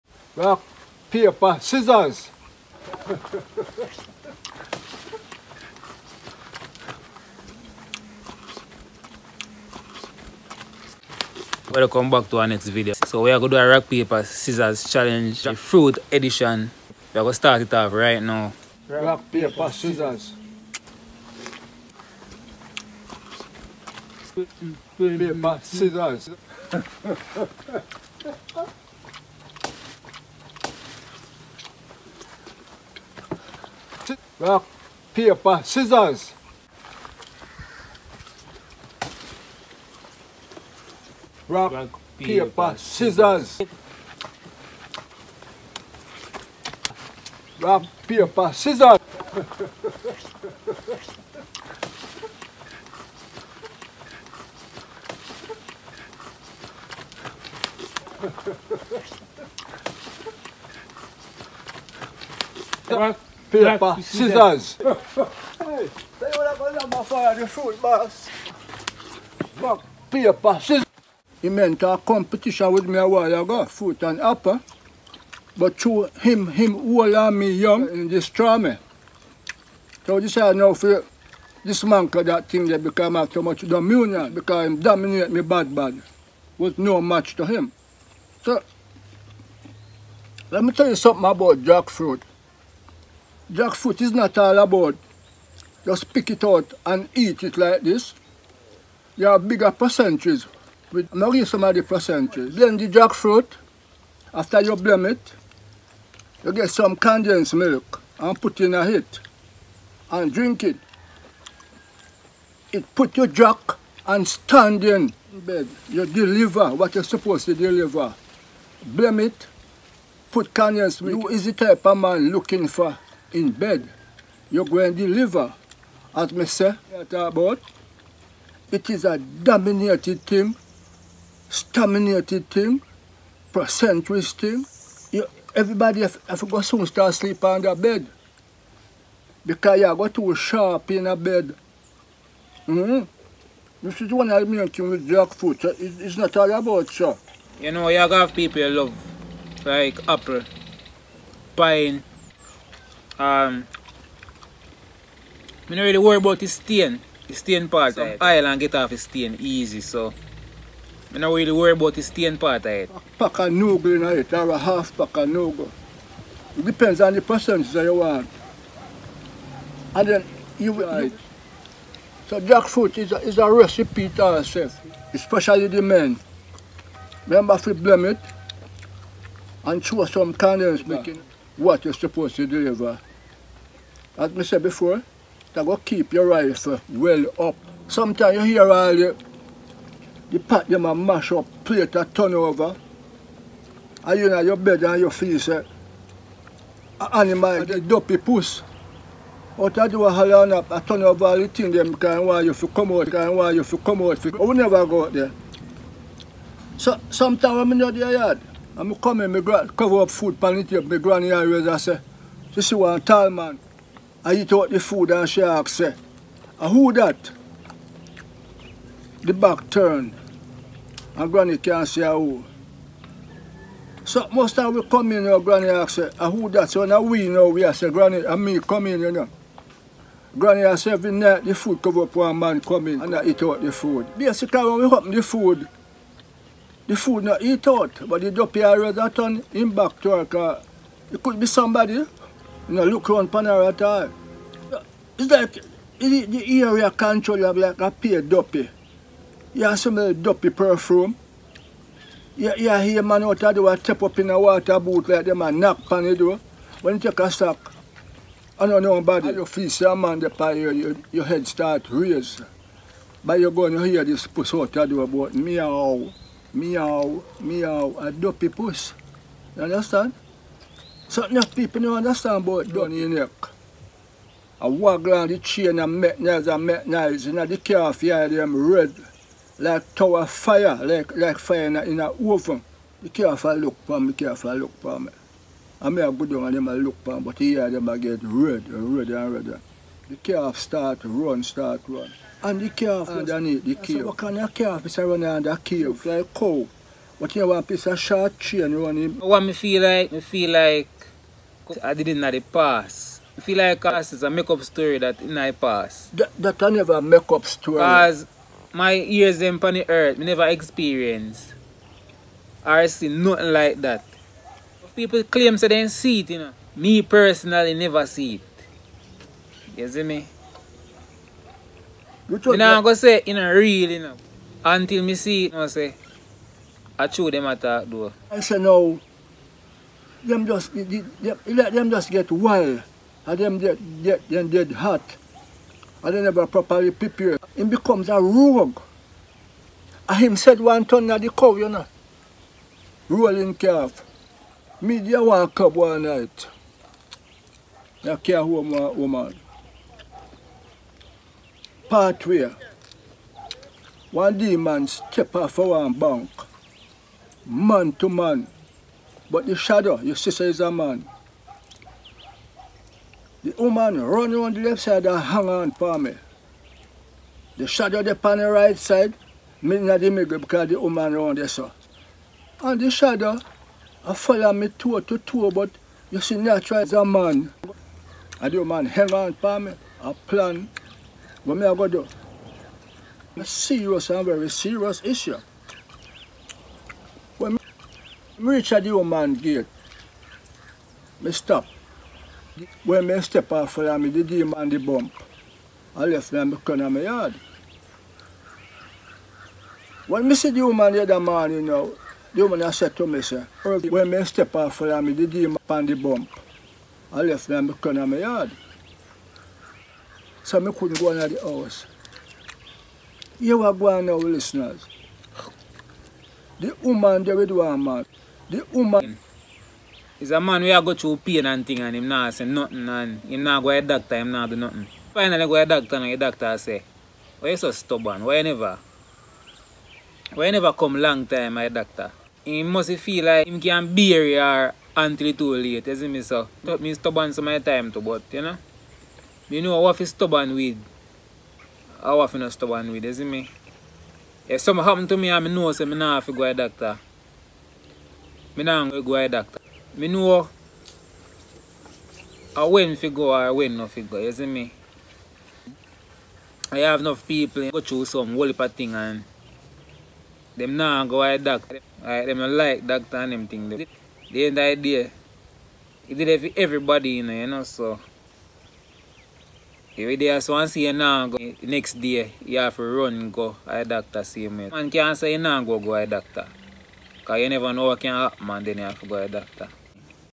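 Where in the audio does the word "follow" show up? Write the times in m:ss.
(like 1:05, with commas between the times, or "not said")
6:14, 6:33, 6:44.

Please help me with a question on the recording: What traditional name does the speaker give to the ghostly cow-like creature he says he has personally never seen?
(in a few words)
Rolling calf.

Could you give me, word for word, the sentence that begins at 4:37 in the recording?
You know, the calf here, them red, like tower fire, like, like fire in a, in a oven.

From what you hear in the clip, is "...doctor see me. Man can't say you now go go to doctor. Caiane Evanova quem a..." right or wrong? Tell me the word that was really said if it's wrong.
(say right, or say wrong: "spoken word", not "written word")
right.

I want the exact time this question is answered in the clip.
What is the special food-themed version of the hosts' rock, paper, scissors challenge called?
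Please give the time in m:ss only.
0:15.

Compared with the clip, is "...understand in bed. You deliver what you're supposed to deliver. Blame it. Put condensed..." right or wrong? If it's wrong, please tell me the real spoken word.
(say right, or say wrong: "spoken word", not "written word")
wrong: "stand", not "understand".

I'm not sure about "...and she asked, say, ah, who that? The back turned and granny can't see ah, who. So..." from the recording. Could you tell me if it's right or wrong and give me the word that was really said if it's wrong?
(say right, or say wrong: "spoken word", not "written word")
right.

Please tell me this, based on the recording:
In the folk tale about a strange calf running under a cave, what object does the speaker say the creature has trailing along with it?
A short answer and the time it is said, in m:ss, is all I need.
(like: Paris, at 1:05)
Short chain, at 4:57.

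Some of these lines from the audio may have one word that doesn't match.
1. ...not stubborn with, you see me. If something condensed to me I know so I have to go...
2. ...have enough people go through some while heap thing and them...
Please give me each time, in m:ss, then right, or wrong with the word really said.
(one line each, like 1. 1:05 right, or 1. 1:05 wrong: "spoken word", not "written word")
1. 7:22 wrong: "happened", not "condensed"
2. 7:36 wrong: "whole", not "while".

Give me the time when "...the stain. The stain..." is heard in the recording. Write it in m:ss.
2:36.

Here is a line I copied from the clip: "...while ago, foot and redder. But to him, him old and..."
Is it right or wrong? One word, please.
wrong.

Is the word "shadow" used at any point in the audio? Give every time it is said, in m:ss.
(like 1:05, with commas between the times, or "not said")
5:59, 6:07, 6:12.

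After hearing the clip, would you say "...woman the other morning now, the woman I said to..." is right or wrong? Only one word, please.
right.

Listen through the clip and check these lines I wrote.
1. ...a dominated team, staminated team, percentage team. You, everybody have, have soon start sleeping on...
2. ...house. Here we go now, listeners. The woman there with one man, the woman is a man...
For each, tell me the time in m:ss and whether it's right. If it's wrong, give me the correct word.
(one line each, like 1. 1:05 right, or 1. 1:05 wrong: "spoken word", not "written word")
1. 2:09 right
2. 6:51 right.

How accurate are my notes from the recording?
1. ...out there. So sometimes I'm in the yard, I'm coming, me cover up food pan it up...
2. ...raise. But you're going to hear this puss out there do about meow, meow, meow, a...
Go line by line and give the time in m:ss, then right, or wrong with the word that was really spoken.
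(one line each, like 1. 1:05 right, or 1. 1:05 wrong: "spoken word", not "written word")
1. 3:25 right
2. 4:21 right.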